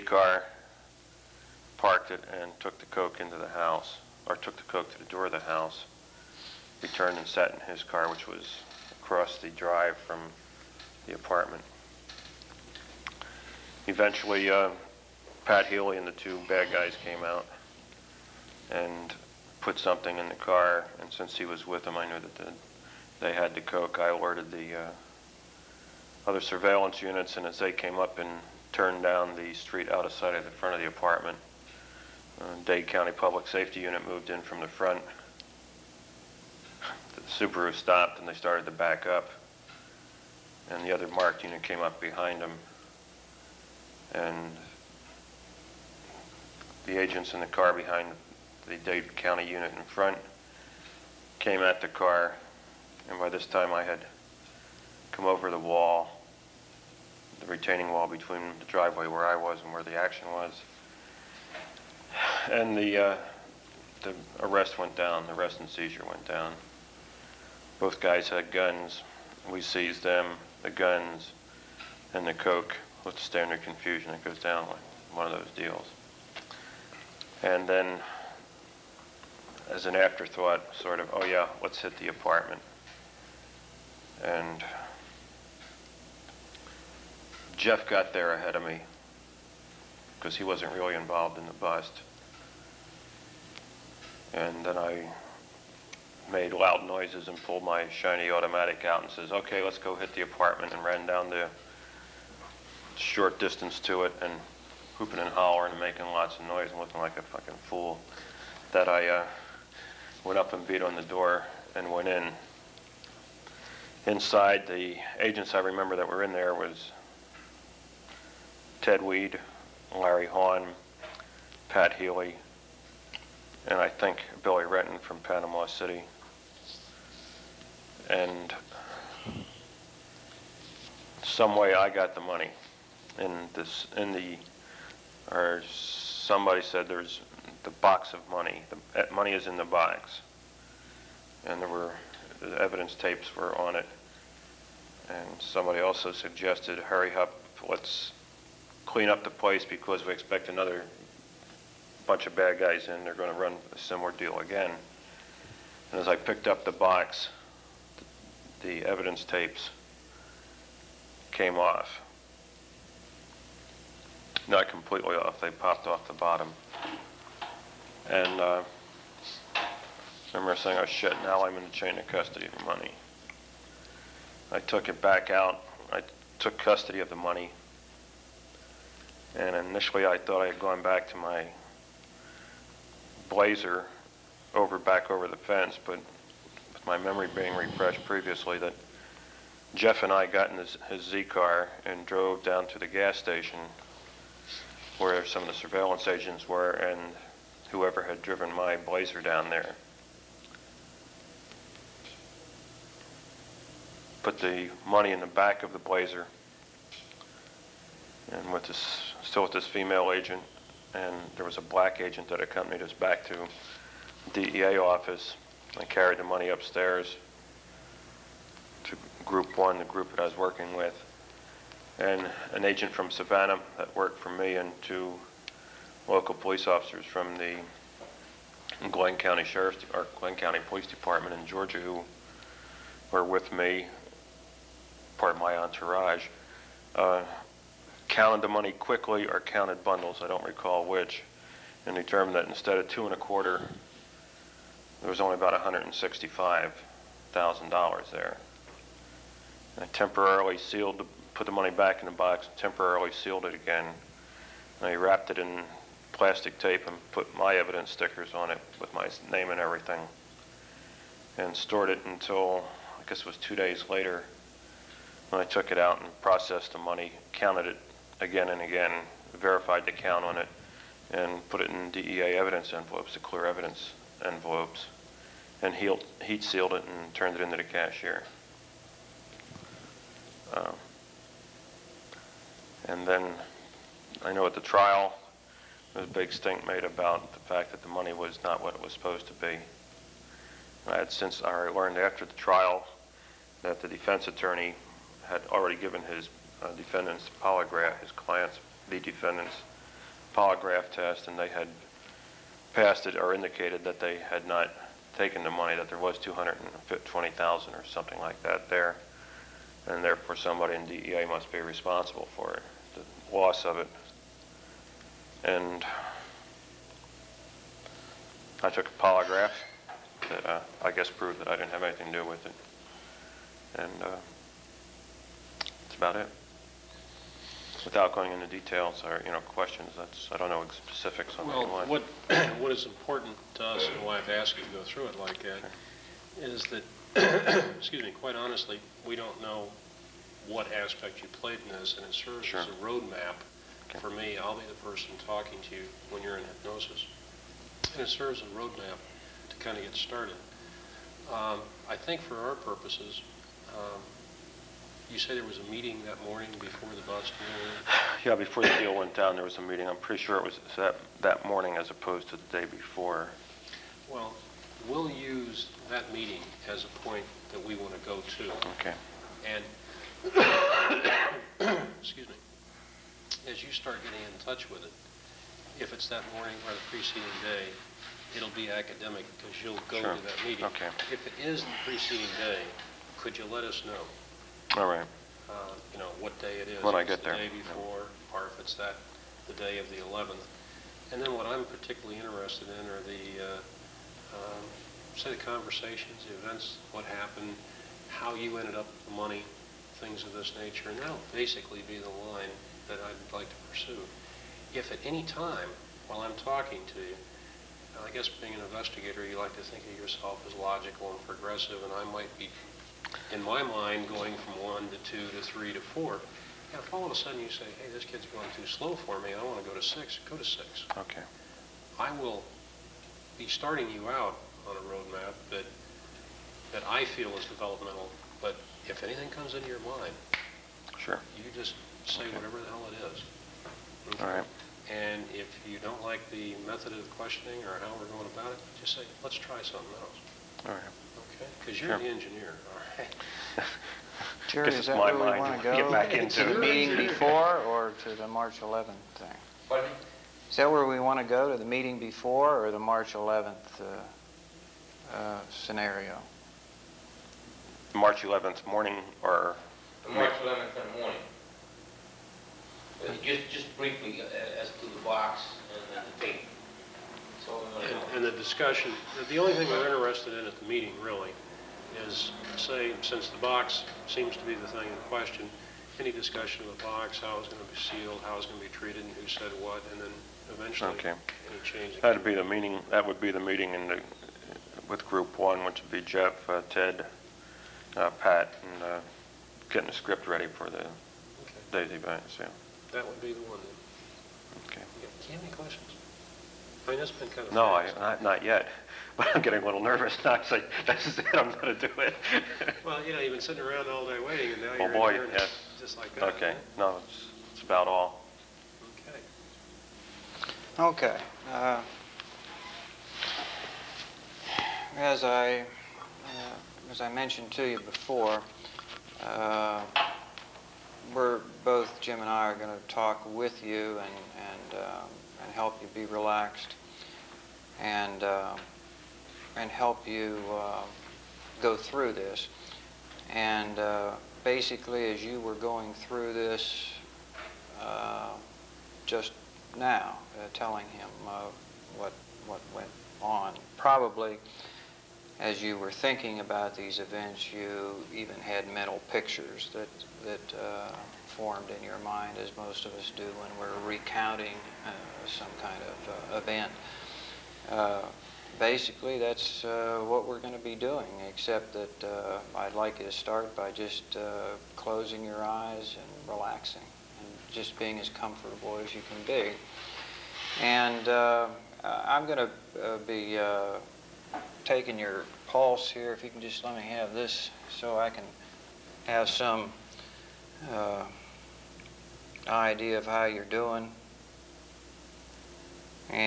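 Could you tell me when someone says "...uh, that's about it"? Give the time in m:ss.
5:24.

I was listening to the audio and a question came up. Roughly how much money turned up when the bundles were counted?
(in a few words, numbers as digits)
$165,000.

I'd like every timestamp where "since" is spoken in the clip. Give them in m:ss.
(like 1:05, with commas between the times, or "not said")
0:21, 4:51, 7:53.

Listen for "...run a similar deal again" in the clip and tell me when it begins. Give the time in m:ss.
2:33.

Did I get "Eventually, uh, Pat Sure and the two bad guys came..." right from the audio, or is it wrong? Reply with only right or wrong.
wrong.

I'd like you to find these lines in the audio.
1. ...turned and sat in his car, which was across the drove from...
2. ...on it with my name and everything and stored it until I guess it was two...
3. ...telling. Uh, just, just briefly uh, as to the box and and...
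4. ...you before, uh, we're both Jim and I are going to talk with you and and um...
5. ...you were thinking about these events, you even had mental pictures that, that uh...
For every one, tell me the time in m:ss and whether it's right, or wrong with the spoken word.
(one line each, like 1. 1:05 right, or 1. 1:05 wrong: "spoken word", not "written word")
1. 0:06 wrong: "drive", not "drove"
2. 4:18 right
3. 7:40 wrong: "morning", not "telling"
4. 8:37 right
5. 9:05 right.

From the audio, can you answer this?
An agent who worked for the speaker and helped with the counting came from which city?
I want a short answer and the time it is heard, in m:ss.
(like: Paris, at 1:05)
Savannah, at 3:43.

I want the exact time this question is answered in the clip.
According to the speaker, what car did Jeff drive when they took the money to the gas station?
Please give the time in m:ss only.
3:11.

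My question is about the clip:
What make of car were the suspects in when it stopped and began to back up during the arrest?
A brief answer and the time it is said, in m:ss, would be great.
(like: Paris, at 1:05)
Subaru, at 0:37.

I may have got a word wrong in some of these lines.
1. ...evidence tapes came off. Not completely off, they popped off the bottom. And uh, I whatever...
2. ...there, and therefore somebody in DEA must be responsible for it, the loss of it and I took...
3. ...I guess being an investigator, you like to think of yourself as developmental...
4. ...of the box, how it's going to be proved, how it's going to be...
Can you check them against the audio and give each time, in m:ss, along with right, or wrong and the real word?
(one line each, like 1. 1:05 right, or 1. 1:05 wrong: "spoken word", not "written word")
1. 2:38 wrong: "remember", not "whatever"
2. 5:08 right
3. 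6:48 wrong: "logical", not "developmental"
4. 7:56 wrong: "sealed", not "proved".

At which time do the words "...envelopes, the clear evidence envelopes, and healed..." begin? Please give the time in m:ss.
4:32.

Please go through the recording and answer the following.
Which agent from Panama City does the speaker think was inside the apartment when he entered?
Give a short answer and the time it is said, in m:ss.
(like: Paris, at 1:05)
Billy Renton, at 2:04.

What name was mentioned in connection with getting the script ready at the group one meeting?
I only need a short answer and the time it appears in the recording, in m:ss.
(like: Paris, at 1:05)
Daisy Banks, at 8:11.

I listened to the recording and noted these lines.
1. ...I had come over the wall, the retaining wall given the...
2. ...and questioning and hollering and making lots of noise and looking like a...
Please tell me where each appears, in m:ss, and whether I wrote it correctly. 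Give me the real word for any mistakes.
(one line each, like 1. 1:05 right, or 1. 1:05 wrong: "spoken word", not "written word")
1. 0:53 wrong: "between", not "given"
2. 1:44 wrong: "hooping", not "questioning".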